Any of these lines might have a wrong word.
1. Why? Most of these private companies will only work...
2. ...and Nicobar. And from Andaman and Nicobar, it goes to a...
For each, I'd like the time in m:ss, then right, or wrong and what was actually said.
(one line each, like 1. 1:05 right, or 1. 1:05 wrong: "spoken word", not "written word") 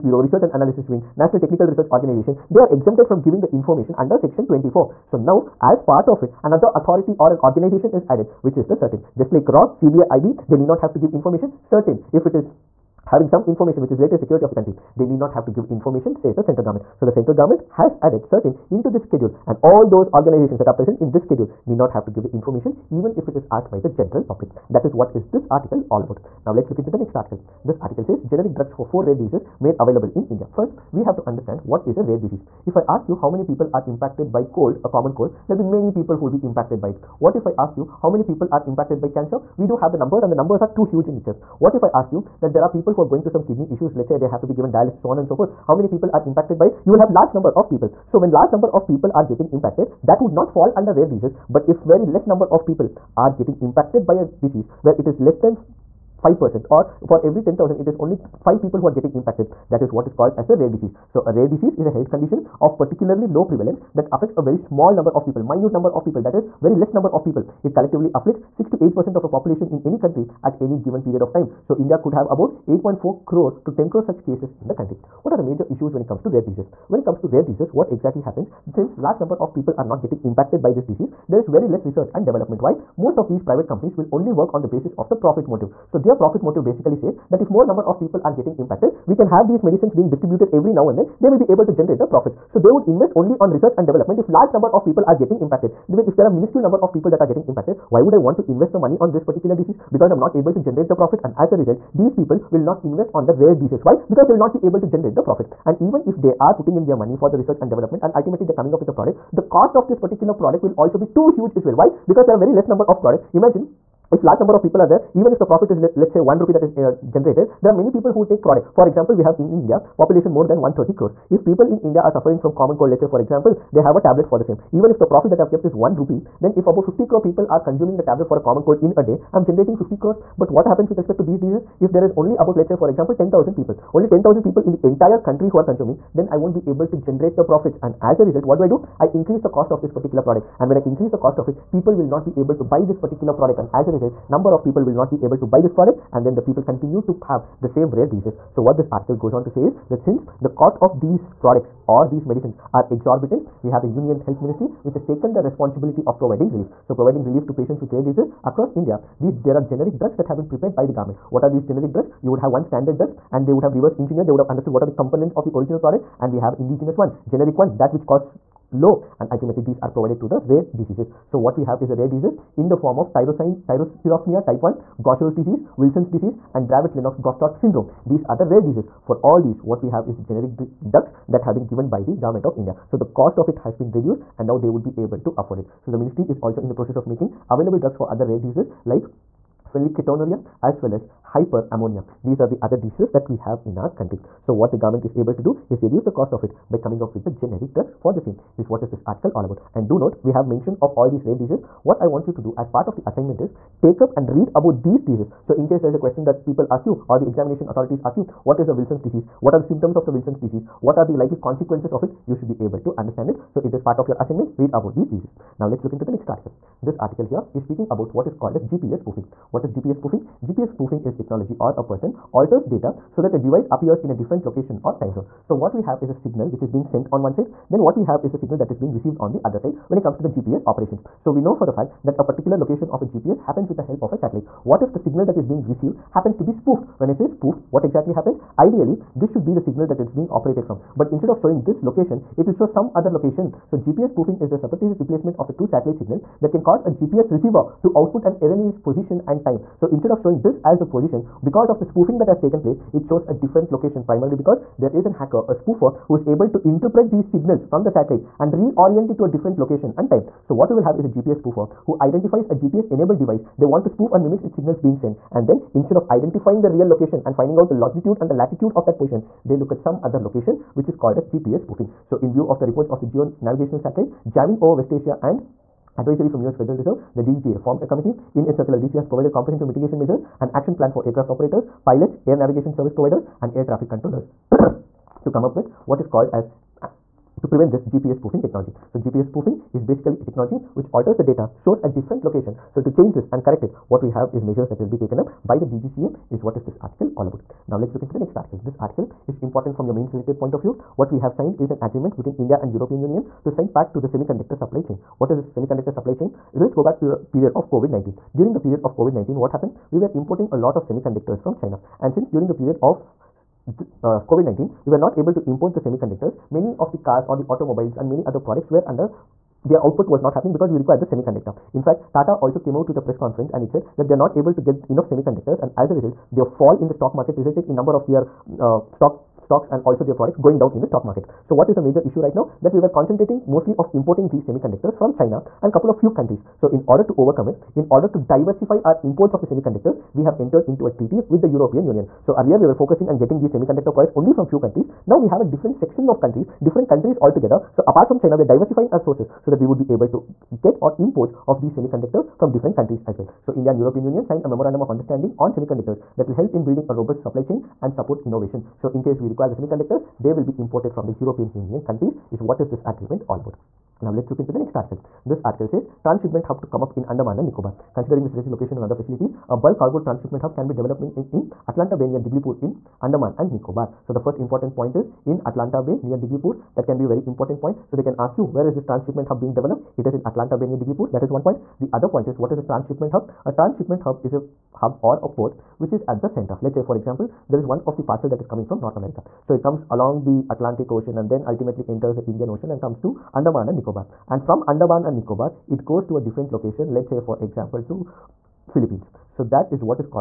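1. 1:22 right
2. 6:33 right.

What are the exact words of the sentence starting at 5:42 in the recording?
So earlier we were focusing and getting these semiconductor products only from few countries.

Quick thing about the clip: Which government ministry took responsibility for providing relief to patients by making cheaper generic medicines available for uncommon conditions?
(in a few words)
Union Health Ministry.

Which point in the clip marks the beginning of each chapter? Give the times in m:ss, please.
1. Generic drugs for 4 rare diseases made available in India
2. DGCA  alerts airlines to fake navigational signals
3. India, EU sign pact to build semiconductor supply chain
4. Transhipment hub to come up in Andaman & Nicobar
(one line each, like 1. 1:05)
1. 0:27
2. 3:36
3. 4:57
4. 6:04.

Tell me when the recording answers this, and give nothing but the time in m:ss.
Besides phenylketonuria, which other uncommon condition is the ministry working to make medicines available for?
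3:11.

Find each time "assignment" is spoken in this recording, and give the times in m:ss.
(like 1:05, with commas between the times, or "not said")
3:23, 3:34.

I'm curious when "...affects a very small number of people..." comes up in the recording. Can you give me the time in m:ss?
1:04.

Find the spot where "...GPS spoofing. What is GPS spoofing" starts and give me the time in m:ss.
3:38.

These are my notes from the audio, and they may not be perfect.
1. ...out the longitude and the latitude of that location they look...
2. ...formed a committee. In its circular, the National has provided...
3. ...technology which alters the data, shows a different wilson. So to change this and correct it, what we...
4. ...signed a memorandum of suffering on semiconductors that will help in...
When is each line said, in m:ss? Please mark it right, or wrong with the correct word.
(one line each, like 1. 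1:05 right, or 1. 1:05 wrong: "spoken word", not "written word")
1. 4:27 wrong: "position", not "location"
2. 4:37 wrong: "DGCA", not "National"
3. 4:50 wrong: "location", not "wilson"
4. 5:54 wrong: "understanding", not "suffering".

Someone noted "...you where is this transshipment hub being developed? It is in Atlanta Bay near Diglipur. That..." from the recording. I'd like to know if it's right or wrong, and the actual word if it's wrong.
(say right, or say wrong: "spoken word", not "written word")
right.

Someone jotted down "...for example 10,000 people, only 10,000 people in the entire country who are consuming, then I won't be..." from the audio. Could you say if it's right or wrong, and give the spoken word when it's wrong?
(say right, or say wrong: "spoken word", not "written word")
right.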